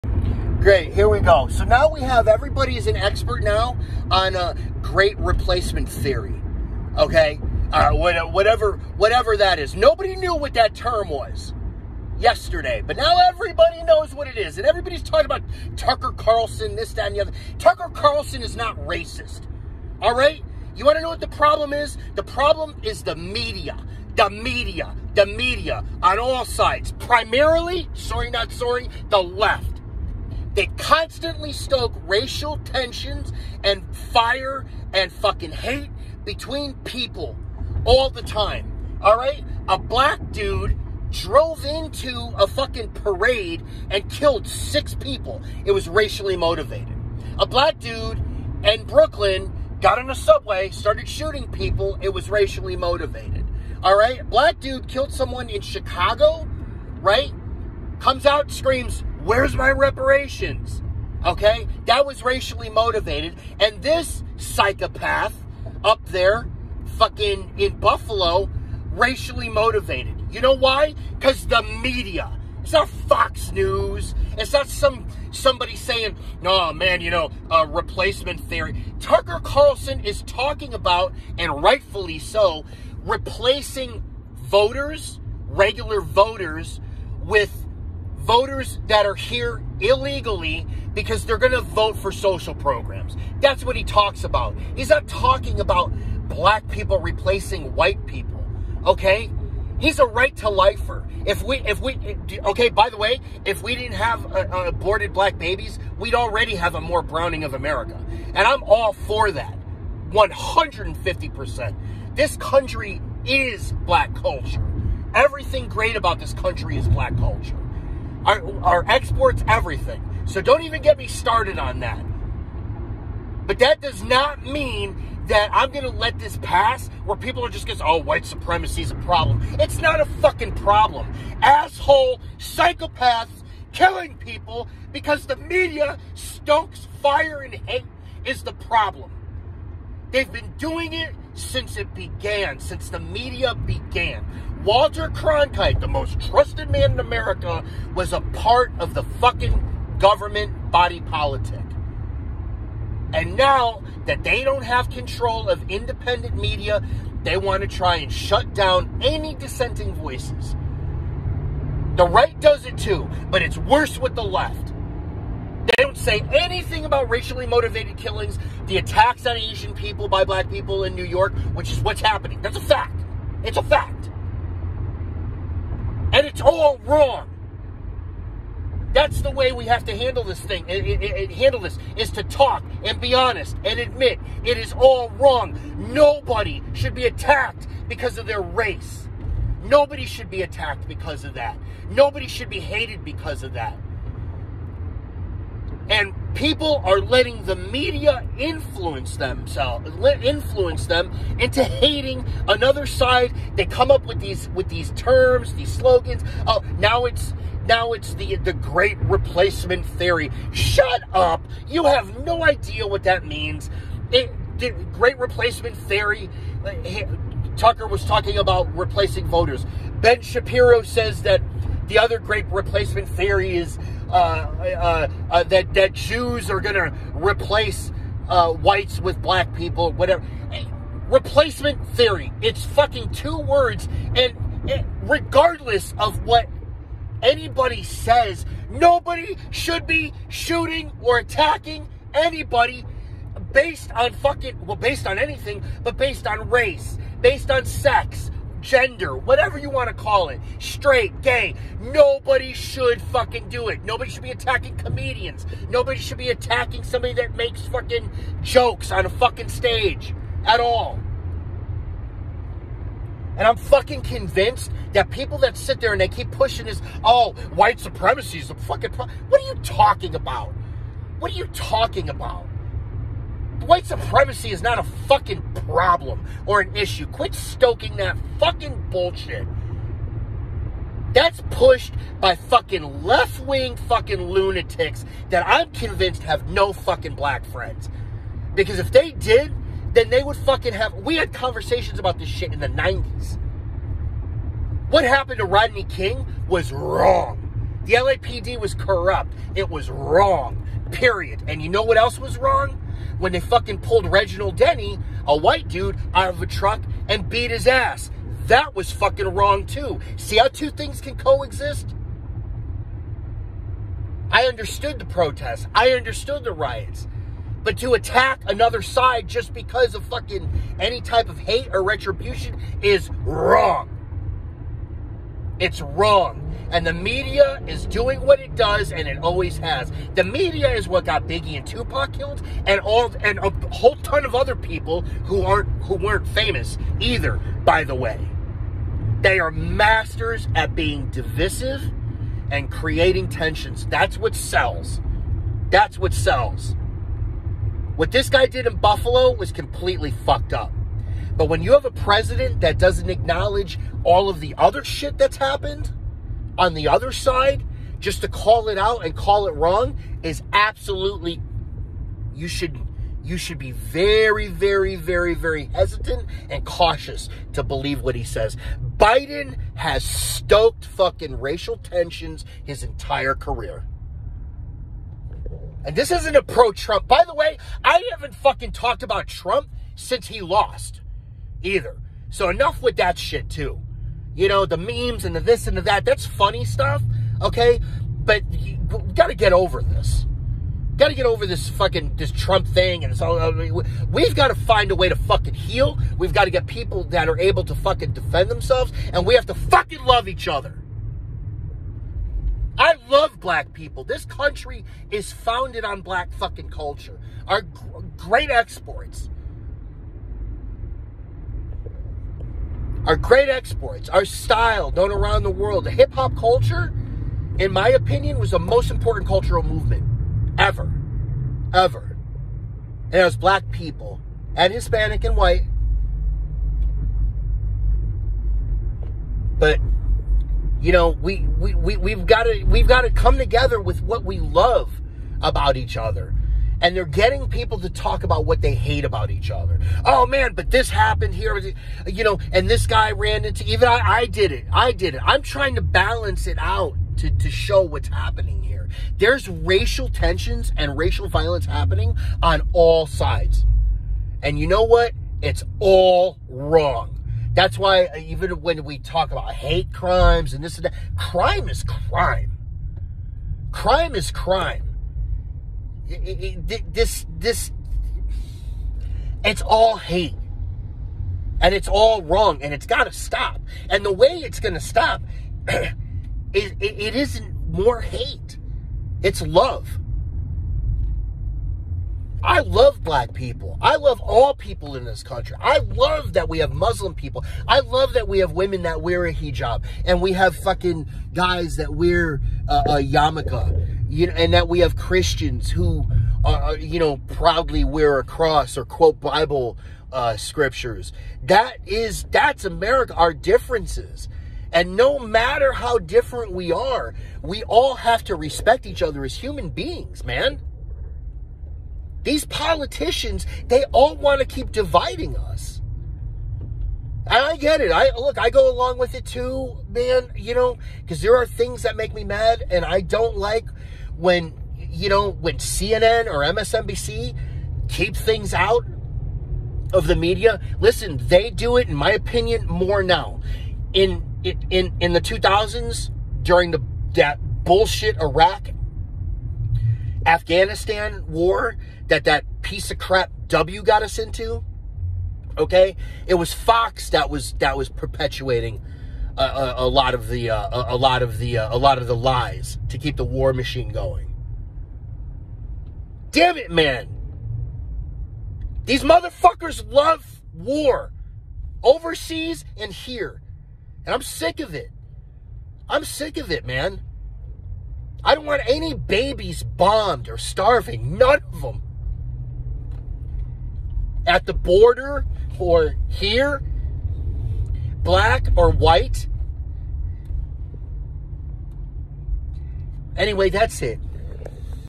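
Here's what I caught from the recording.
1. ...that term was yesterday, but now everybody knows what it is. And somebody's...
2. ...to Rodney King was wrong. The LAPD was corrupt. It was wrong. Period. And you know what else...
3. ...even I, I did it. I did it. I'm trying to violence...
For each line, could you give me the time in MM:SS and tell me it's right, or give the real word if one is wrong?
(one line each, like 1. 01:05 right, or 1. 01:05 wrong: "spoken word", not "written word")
1. 00:10 wrong: "everybody", not "somebody"
2. 04:55 right
3. 07:23 wrong: "balance", not "violence".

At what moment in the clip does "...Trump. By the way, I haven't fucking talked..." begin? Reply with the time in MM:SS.
06:16.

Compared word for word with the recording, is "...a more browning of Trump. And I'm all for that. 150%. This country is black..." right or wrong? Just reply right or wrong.
wrong.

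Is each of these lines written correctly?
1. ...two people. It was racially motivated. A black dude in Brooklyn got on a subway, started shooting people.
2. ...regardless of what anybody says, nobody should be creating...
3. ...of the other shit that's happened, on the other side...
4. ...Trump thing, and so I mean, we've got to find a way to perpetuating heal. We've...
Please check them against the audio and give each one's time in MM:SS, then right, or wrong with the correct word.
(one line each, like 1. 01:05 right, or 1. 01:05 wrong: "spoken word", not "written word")
1. 00:44 wrong: "six", not "two"
2. 03:55 wrong: "shooting", not "creating"
3. 05:54 right
4. 06:32 wrong: "fucking", not "perpetuating".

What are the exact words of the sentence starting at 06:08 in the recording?
Biden has stoked fucking racial tensions his entire career.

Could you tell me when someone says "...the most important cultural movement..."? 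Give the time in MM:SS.
06:58.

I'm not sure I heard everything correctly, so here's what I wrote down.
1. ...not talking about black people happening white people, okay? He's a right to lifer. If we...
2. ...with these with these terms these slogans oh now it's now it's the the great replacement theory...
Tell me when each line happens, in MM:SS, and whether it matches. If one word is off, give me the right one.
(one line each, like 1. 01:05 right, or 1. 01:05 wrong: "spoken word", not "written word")
1. 01:34 wrong: "replacing", not "happening"
2. 03:24 right.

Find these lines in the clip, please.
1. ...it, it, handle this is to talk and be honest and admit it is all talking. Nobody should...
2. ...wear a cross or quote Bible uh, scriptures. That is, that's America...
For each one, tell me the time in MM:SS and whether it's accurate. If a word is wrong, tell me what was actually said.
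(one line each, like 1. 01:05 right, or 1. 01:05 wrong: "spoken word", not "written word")
1. 03:00 wrong: "wrong", not "talking"
2. 08:17 right.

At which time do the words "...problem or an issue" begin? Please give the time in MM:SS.
04:35.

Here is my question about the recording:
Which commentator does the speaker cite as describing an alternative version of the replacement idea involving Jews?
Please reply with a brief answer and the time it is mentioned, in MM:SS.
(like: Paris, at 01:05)
Ben Shapiro, at 03:39.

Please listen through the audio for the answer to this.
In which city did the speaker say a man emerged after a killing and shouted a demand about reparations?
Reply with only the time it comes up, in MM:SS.
00:55.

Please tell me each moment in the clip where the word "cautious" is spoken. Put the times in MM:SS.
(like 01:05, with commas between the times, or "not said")
06:06.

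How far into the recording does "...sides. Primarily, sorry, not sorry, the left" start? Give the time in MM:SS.
00:26.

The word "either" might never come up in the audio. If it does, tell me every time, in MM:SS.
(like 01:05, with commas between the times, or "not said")
05:37, 06:21.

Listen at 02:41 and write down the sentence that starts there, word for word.
The right does it too, but it's worse with the left.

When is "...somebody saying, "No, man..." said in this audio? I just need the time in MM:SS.
01:15.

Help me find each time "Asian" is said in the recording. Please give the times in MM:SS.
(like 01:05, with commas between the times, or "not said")
02:49.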